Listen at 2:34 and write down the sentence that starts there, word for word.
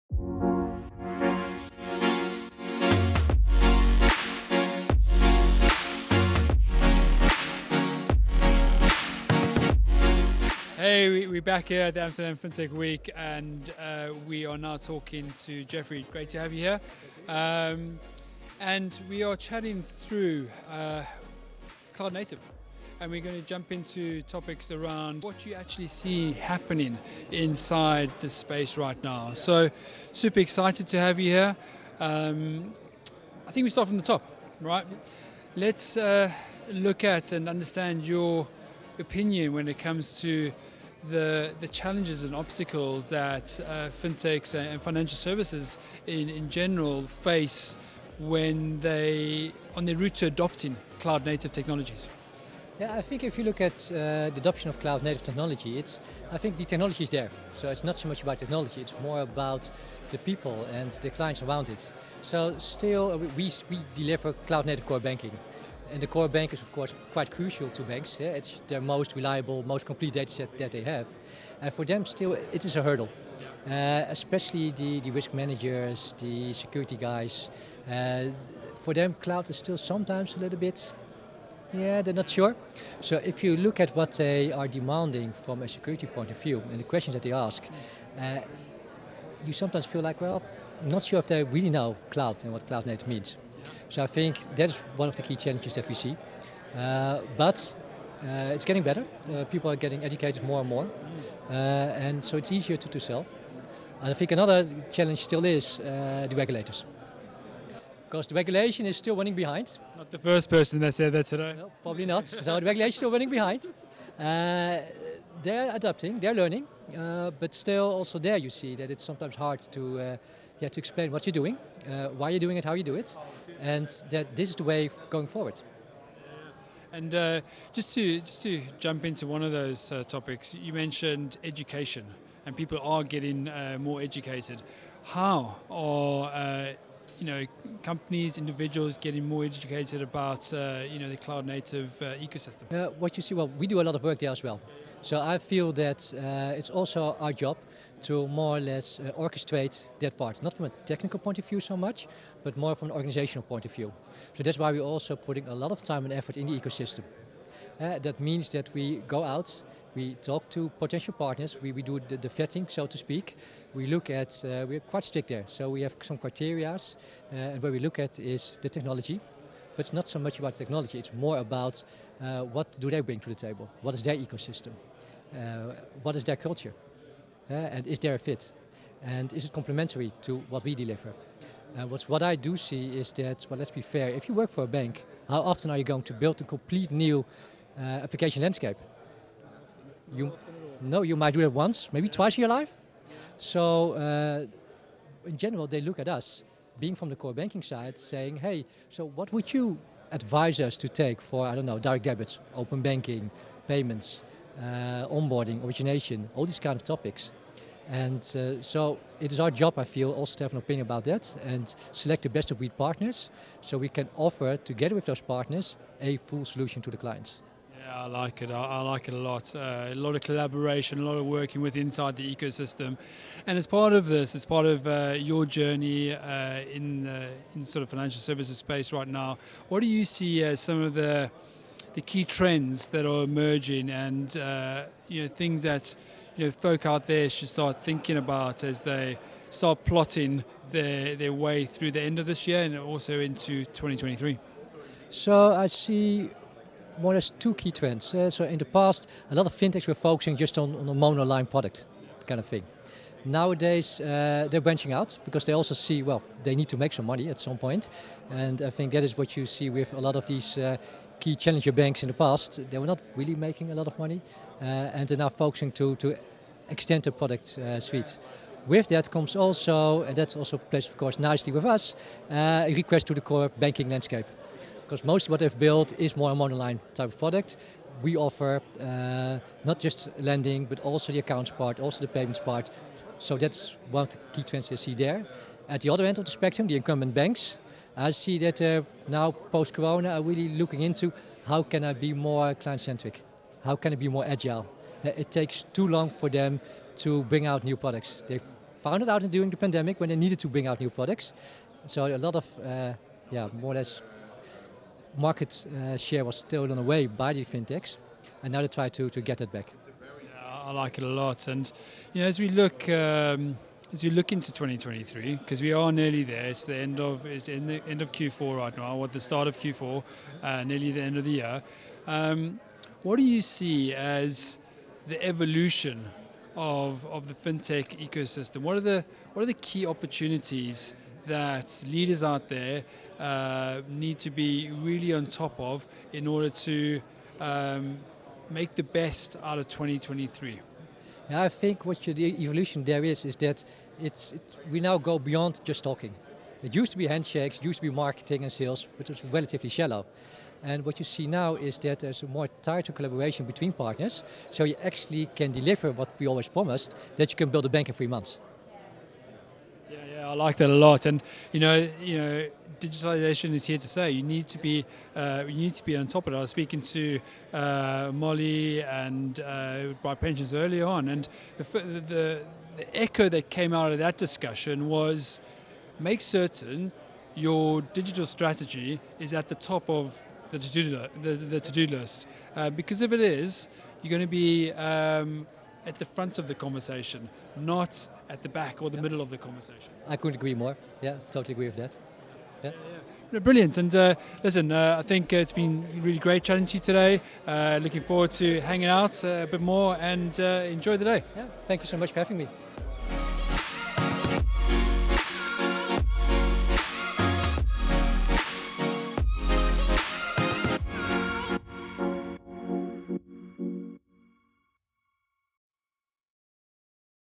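So that's why we're also putting a lot of time and effort in the ecosystem.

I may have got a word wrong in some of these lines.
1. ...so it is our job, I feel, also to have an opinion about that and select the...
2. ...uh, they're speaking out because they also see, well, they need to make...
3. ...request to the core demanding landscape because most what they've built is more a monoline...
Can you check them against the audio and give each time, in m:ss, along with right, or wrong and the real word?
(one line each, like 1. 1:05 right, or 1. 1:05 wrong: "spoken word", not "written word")
1. 3:28 right
2. 4:13 wrong: "branching", not "speaking"
3. 4:32 wrong: "banking", not "demanding".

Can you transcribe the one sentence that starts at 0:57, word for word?
So it's not so much about technology; it's more about the people and the clients around it.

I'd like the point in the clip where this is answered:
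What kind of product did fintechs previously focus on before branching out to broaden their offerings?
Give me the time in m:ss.
4:10.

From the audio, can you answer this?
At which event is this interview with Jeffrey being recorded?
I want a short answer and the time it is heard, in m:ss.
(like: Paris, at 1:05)
Amsterdam FinTech Week, at 0:12.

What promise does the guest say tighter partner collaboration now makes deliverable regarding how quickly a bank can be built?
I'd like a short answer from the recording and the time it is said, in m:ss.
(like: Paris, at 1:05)
Three months, at 5:57.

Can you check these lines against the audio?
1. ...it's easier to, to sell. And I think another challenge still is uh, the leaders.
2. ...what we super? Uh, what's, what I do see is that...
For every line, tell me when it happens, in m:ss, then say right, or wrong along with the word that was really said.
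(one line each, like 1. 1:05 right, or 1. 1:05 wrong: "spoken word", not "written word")
1. 1:42 wrong: "regulators", not "leaders"
2. 3:00 wrong: "deliver", not "super".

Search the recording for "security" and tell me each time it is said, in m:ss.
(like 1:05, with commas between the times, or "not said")
1:16, 1:25.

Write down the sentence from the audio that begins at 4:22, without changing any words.
They were not really making a lot of money and they're now focusing to, to extend the product suite.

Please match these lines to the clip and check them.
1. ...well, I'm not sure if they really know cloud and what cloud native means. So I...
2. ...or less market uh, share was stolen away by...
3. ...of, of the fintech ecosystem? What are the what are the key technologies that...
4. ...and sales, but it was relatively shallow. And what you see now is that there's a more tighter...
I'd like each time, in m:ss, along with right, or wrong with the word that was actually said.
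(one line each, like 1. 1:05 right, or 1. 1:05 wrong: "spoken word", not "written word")
1. 1:30 right
2. 5:03 right
3. 5:26 wrong: "opportunities", not "technologies"
4. 5:48 right.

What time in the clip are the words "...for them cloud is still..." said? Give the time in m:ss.
1:18.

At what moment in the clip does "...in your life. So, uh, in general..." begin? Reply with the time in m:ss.
3:12.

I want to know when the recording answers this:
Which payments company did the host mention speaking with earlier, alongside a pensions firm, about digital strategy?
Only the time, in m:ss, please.
6:08.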